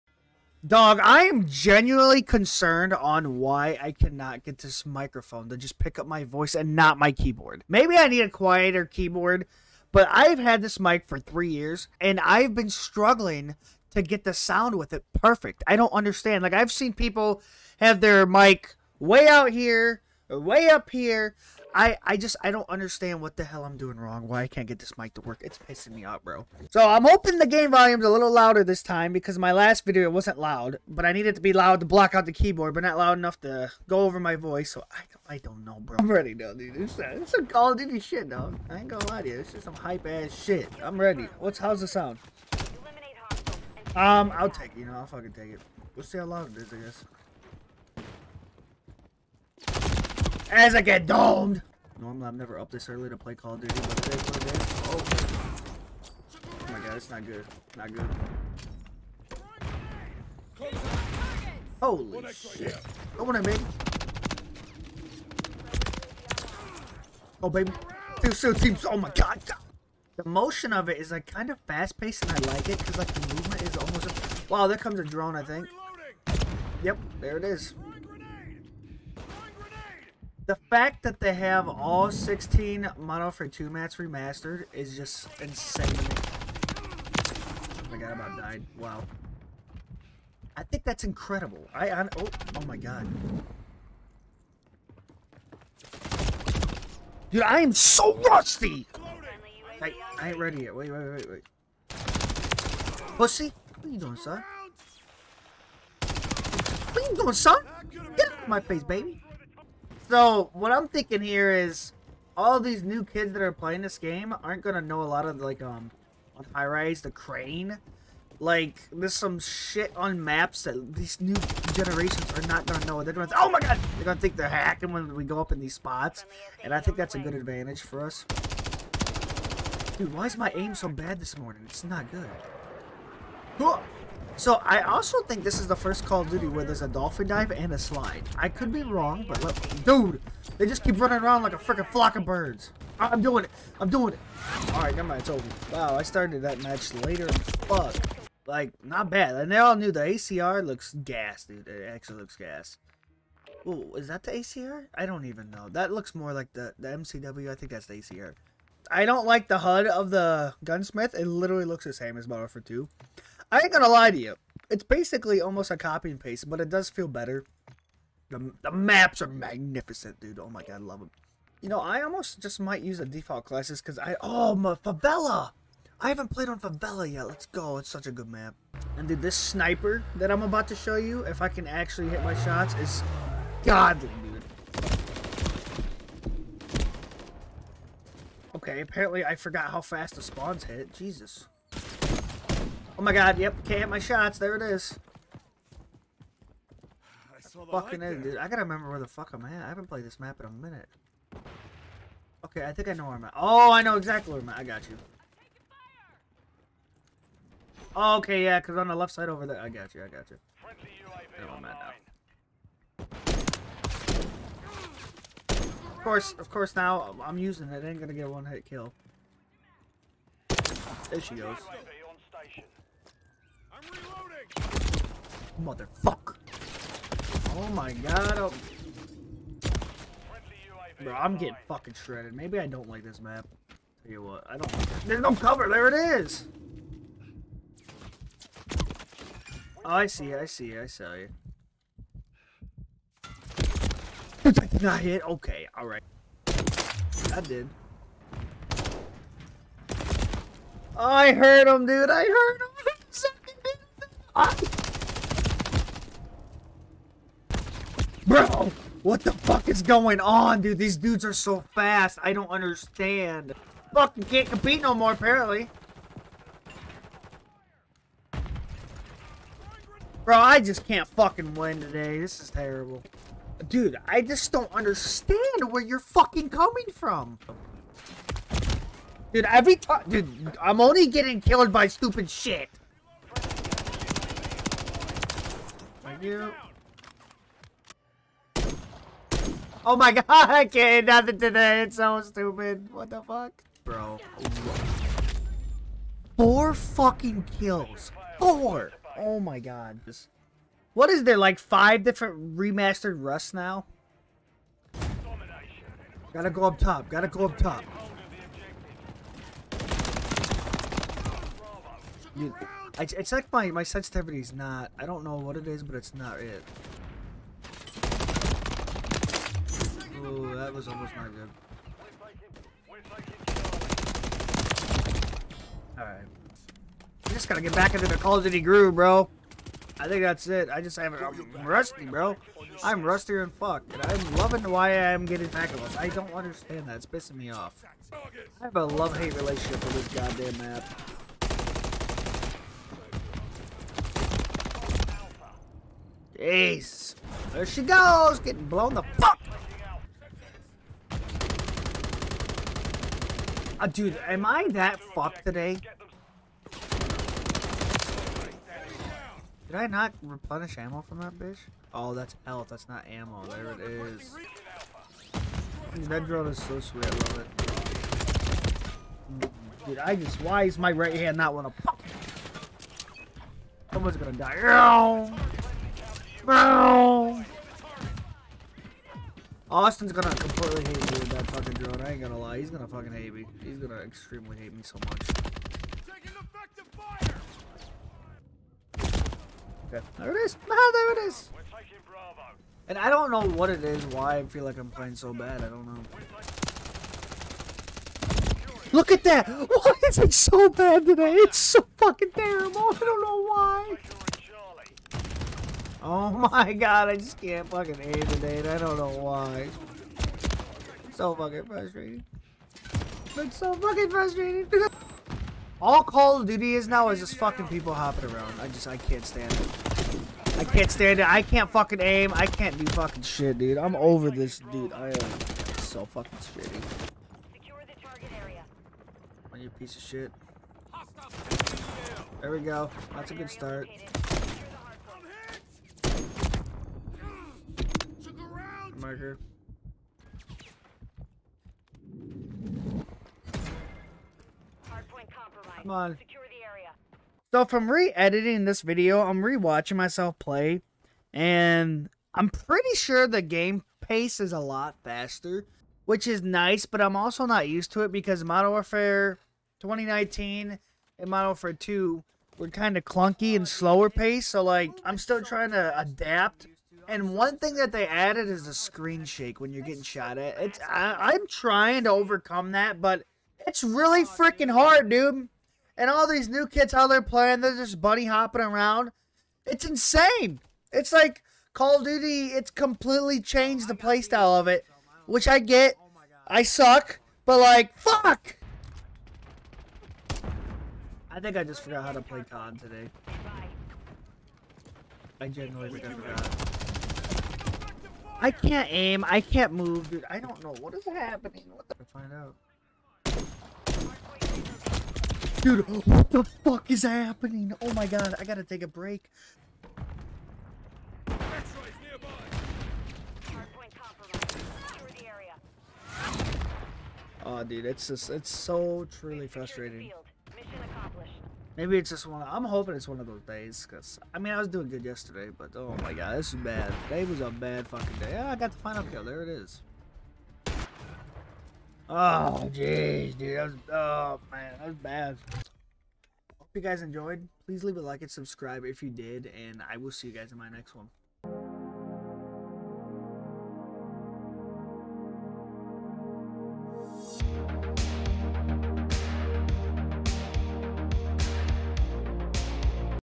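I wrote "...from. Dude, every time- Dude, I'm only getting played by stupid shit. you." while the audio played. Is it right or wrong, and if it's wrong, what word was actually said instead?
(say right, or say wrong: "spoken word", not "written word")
wrong: "killed", not "played".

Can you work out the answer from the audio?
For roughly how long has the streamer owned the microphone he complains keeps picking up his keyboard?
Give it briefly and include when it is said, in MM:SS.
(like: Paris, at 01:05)
3 years, at 00:11.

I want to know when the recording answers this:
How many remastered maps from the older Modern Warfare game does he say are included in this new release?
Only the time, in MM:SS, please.
01:22.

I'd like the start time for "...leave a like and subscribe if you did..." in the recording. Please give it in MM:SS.
08:57.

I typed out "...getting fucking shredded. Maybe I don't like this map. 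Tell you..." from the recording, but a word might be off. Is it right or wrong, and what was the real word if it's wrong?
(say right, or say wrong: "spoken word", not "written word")
right.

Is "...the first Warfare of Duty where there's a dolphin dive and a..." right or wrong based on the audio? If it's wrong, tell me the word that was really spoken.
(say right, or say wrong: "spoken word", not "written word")
wrong: "Call", not "Warfare".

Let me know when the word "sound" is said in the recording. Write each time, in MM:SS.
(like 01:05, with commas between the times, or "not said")
00:14, 00:41.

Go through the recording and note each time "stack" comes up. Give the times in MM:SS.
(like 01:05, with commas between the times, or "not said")
not said.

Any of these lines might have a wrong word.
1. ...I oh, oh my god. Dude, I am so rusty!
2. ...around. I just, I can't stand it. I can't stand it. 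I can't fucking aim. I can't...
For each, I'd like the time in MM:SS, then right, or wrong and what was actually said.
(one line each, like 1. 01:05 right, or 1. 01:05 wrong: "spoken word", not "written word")
1. 01:31 right
2. 06:58 right.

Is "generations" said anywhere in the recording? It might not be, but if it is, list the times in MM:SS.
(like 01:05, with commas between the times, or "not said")
02:01.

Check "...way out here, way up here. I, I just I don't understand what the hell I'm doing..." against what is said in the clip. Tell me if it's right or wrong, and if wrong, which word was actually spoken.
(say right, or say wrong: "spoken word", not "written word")
right.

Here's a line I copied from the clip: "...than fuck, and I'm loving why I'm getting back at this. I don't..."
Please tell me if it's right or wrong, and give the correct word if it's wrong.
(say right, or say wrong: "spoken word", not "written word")
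right.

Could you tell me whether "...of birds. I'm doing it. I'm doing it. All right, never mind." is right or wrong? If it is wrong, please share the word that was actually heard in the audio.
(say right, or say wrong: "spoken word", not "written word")
right.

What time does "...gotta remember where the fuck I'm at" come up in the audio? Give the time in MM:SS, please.
03:18.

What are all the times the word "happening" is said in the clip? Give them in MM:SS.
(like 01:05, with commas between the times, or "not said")
08:21, 08:27.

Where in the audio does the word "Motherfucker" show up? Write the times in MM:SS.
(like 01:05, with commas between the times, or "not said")
03:45.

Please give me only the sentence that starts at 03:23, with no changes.
Oh, I know exactly where I'm at.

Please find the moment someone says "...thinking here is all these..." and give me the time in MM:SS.
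01:50.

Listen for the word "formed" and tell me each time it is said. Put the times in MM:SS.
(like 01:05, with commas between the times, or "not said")
not said.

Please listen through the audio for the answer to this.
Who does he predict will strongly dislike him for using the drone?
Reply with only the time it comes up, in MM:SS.
06:16.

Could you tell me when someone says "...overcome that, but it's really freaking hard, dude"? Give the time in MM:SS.
07:52.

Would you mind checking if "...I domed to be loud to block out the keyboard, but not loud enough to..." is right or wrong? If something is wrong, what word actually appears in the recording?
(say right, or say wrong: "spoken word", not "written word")
wrong: "needed", not "domed".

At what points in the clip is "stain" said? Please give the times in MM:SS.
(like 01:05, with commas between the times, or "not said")
not said.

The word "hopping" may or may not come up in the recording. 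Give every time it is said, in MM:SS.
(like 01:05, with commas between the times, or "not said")
06:57, 07:58.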